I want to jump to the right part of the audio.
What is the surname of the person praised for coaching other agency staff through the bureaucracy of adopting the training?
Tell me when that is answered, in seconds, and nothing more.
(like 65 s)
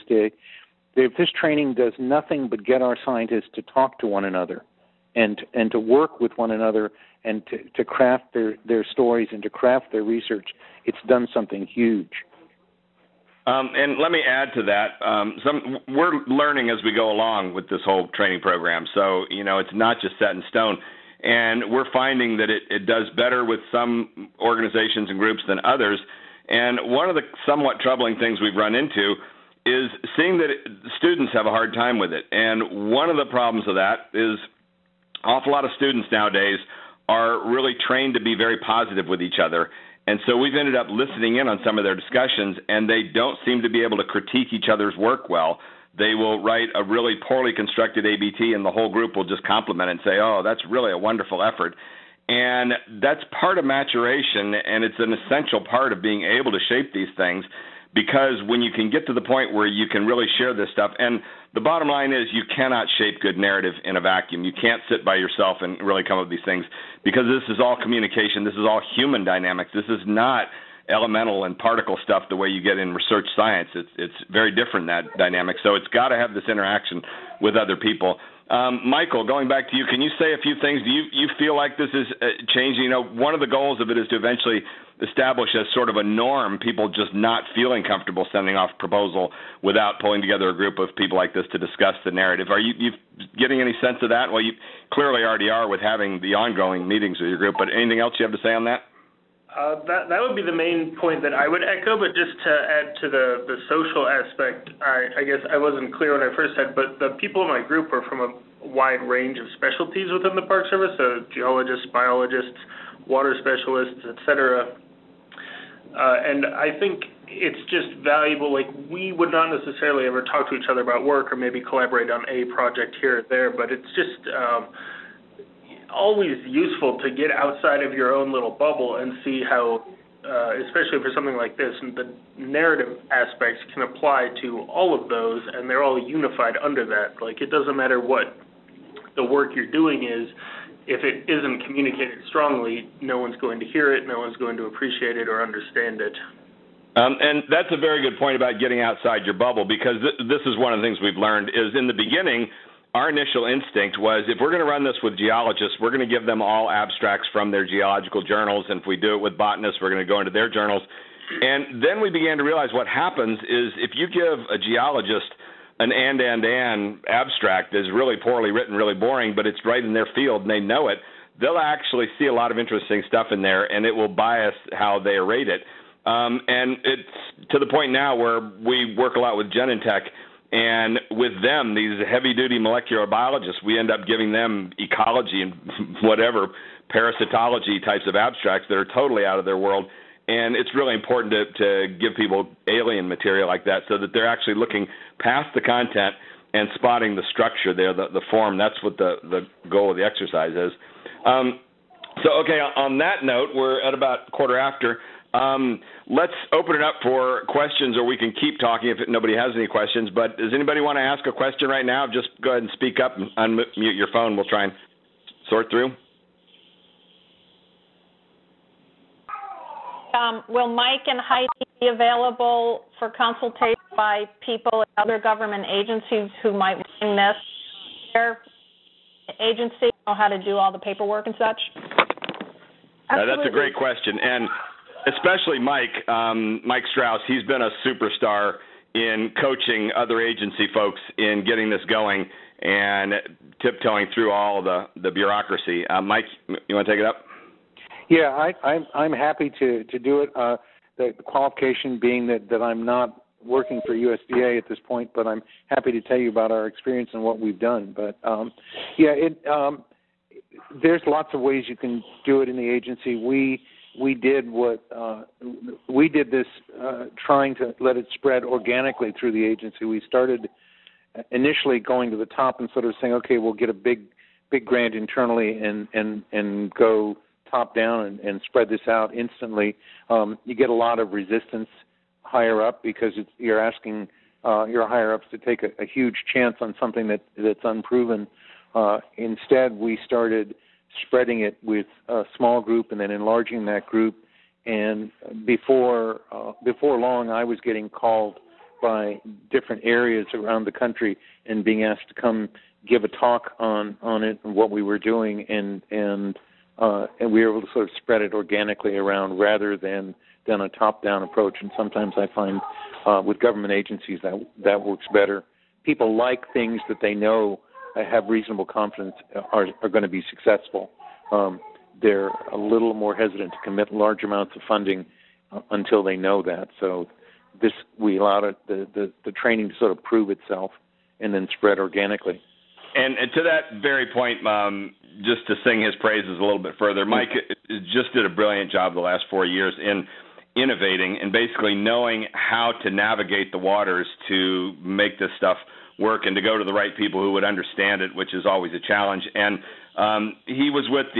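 236 s.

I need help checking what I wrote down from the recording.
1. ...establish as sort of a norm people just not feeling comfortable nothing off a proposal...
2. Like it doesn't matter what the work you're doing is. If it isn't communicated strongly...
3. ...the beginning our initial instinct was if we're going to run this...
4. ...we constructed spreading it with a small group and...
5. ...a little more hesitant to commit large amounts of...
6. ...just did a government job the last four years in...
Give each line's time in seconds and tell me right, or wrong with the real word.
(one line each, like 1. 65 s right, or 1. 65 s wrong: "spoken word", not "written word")
1. 85 s wrong: "sending", not "nothing"
2. 137 s right
3. 151 s right
4. 289 s wrong: "started", not "constructed"
5. 322 s right
6. 337 s wrong: "brilliant", not "government".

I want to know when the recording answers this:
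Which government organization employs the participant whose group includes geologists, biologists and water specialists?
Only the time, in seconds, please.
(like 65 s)
110 s.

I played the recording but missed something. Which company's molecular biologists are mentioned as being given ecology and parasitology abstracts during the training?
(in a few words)
Genentech.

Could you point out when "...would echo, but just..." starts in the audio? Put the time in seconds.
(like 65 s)
101 s.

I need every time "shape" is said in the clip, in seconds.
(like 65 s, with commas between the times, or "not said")
56 s, 62 s.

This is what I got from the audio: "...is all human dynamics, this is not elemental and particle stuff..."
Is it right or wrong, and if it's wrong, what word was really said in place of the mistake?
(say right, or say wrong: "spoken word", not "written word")
right.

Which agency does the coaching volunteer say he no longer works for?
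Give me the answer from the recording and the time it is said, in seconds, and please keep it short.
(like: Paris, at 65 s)
USDA, at 253 s.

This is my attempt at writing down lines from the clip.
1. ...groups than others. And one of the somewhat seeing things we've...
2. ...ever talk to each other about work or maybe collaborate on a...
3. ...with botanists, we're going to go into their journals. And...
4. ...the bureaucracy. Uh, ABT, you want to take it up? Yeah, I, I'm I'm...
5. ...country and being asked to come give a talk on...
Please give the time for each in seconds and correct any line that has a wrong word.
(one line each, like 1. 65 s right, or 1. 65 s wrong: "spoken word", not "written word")
1. 25 s wrong: "troubling", not "seeing"
2. 120 s right
3. 159 s right
4. 244 s wrong: "Mike", not "ABT"
5. 300 s right.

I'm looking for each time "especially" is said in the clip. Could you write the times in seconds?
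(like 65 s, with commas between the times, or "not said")
130 s, 235 s.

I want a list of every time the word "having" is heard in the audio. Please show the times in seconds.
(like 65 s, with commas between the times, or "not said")
95 s.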